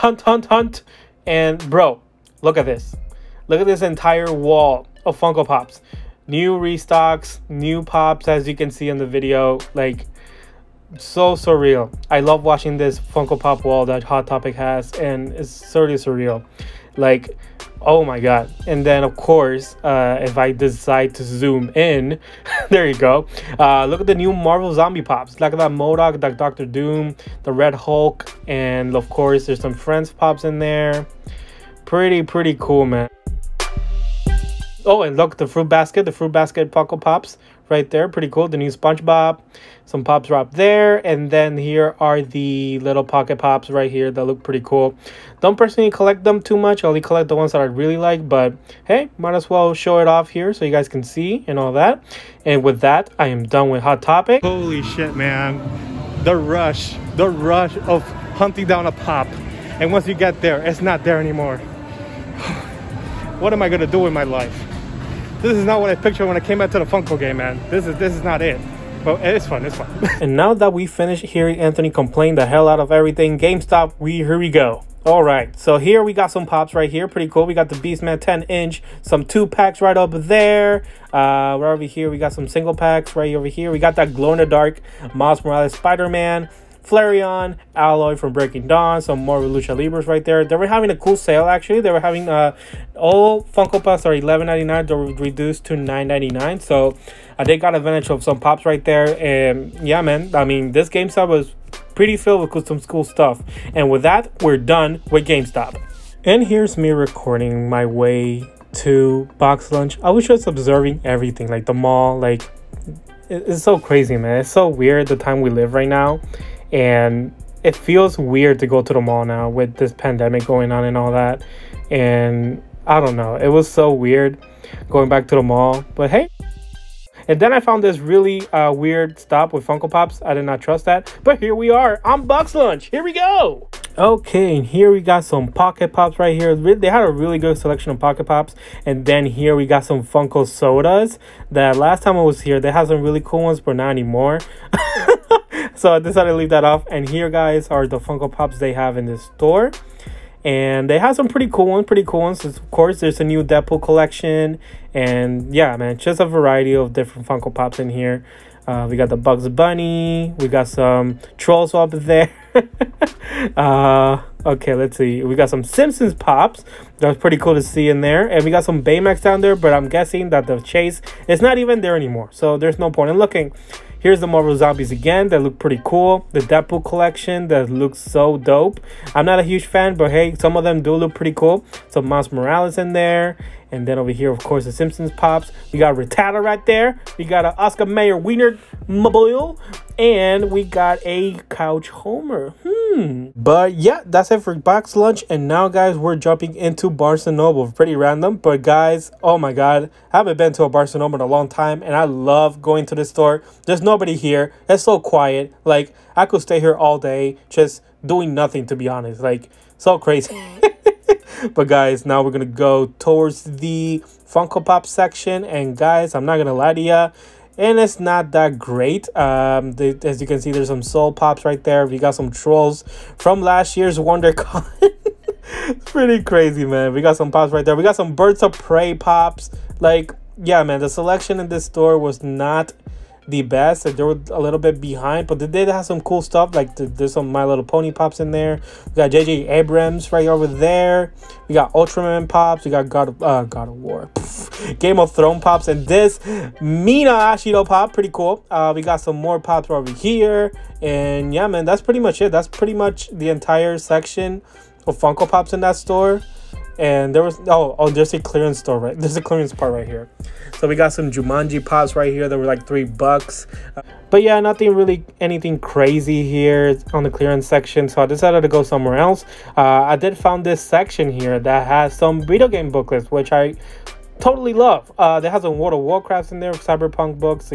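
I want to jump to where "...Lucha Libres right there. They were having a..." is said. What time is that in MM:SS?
01:29.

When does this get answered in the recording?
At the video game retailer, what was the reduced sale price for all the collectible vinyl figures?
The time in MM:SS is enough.
01:35.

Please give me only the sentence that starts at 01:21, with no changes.
Uh, right over here, we got some single packs right over here.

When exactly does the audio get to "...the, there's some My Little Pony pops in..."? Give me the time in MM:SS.
03:56.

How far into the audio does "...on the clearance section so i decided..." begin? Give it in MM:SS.
04:26.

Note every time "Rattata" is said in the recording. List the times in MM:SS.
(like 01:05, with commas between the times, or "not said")
03:05.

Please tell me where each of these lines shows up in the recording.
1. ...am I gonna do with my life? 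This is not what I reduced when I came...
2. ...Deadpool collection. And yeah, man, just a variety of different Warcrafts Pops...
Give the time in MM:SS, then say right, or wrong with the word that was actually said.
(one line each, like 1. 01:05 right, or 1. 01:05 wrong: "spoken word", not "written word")
1. 01:03 wrong: "pictured", not "reduced"
2. 02:33 wrong: "Funko", not "Warcrafts".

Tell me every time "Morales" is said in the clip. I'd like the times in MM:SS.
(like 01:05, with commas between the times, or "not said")
01:25, 03:02.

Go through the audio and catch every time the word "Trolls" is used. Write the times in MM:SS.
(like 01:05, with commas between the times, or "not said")
02:41, 03:42.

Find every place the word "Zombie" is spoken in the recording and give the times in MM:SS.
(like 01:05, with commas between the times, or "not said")
00:24, 02:54.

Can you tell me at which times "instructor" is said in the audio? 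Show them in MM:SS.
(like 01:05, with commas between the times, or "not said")
not said.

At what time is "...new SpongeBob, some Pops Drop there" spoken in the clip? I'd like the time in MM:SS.
00:38.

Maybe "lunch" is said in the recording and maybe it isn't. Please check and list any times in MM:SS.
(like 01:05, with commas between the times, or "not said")
01:49, 02:12, 03:14.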